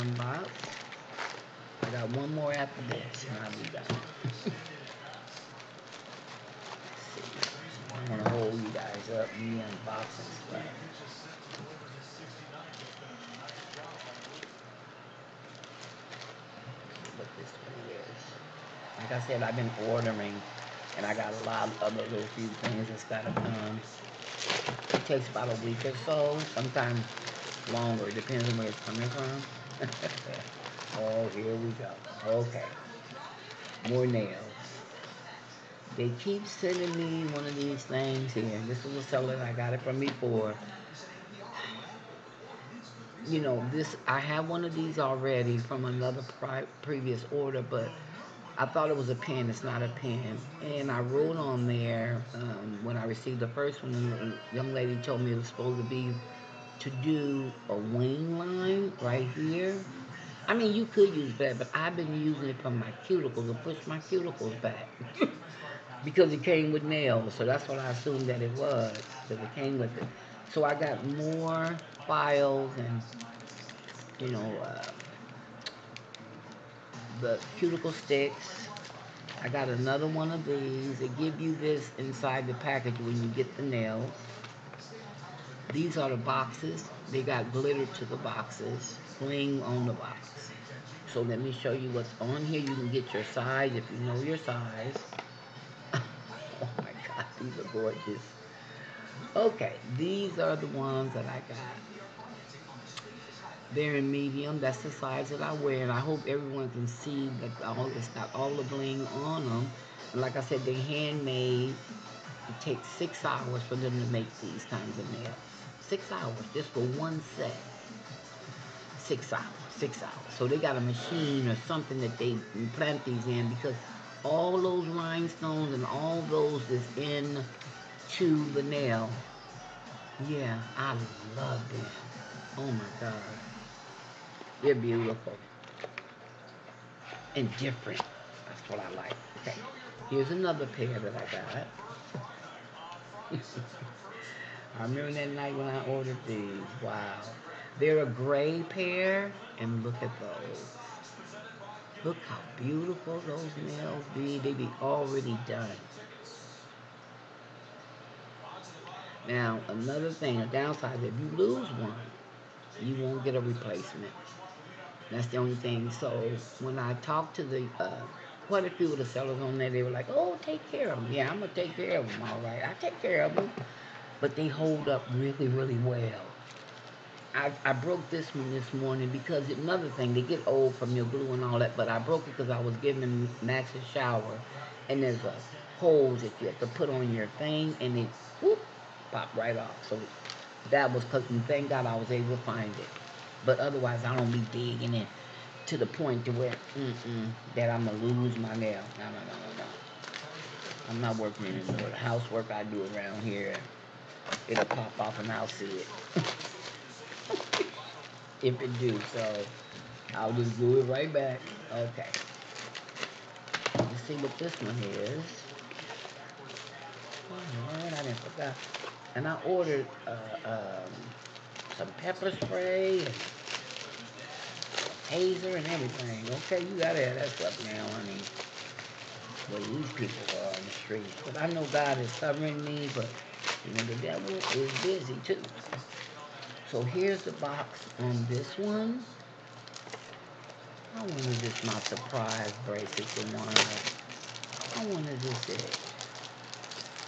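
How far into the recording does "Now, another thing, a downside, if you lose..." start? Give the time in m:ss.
2:39.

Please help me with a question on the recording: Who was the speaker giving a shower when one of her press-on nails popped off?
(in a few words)
Max.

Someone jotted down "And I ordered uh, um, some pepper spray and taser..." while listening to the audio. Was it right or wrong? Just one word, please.
right.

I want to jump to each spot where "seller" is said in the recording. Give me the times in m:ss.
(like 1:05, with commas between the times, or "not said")
0:39, 2:49.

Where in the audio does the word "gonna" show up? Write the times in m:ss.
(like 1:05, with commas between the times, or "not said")
0:08, 2:51, 3:17.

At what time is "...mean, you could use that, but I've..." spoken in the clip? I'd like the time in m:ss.
1:00.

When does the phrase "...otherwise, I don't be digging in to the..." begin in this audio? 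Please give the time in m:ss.
3:13.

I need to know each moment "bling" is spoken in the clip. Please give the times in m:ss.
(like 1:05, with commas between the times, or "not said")
1:29, 1:48.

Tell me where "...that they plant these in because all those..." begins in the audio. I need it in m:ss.
2:02.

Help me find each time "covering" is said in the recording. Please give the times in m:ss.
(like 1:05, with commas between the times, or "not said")
3:52.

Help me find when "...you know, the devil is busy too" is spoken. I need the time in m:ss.
3:53.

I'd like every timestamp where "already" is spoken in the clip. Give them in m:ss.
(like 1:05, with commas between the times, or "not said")
0:44, 2:34.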